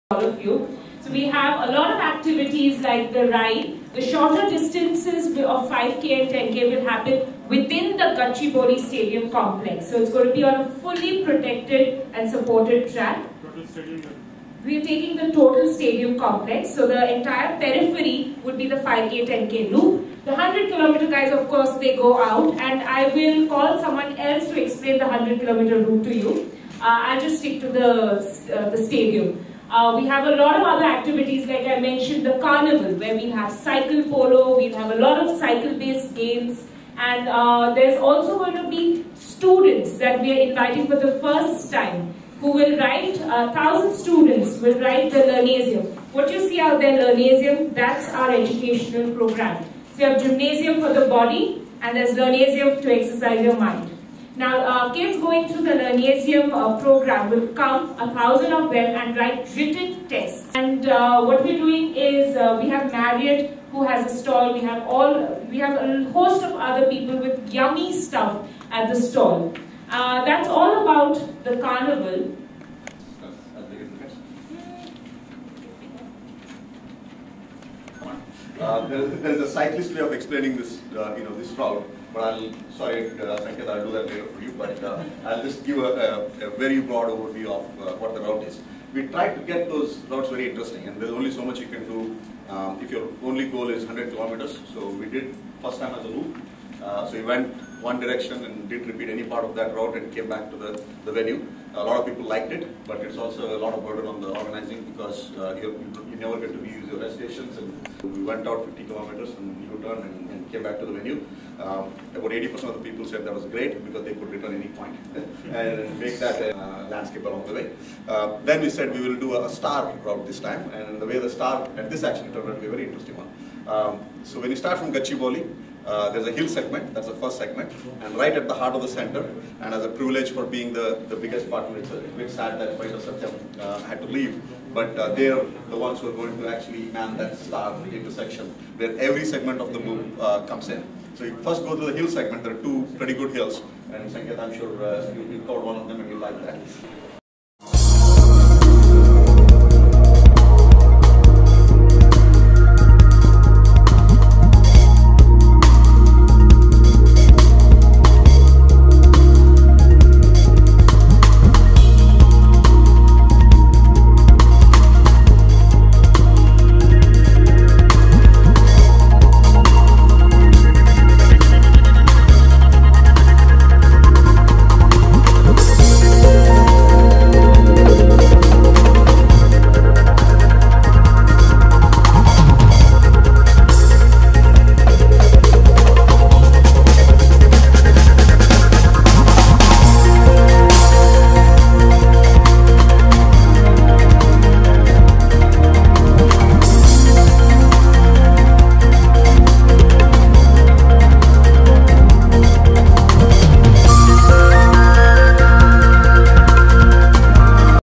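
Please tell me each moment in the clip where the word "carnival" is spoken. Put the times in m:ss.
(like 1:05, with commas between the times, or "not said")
0:32, 1:11.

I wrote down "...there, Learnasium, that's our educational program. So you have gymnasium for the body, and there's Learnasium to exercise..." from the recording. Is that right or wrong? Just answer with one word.
right.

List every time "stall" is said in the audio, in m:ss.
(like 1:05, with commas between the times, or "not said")
1:04, 1:08.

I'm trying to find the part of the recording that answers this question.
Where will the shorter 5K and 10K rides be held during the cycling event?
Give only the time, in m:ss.
0:08.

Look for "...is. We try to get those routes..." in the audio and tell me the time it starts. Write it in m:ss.
1:28.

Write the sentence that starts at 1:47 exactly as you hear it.
And we went out 50 kilometers and U-turn and, and, came back to the venue.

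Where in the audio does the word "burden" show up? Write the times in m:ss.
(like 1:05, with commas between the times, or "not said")
1:43.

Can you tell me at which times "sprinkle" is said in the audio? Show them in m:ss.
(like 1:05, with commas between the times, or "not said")
not said.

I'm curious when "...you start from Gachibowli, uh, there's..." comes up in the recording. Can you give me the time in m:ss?
2:04.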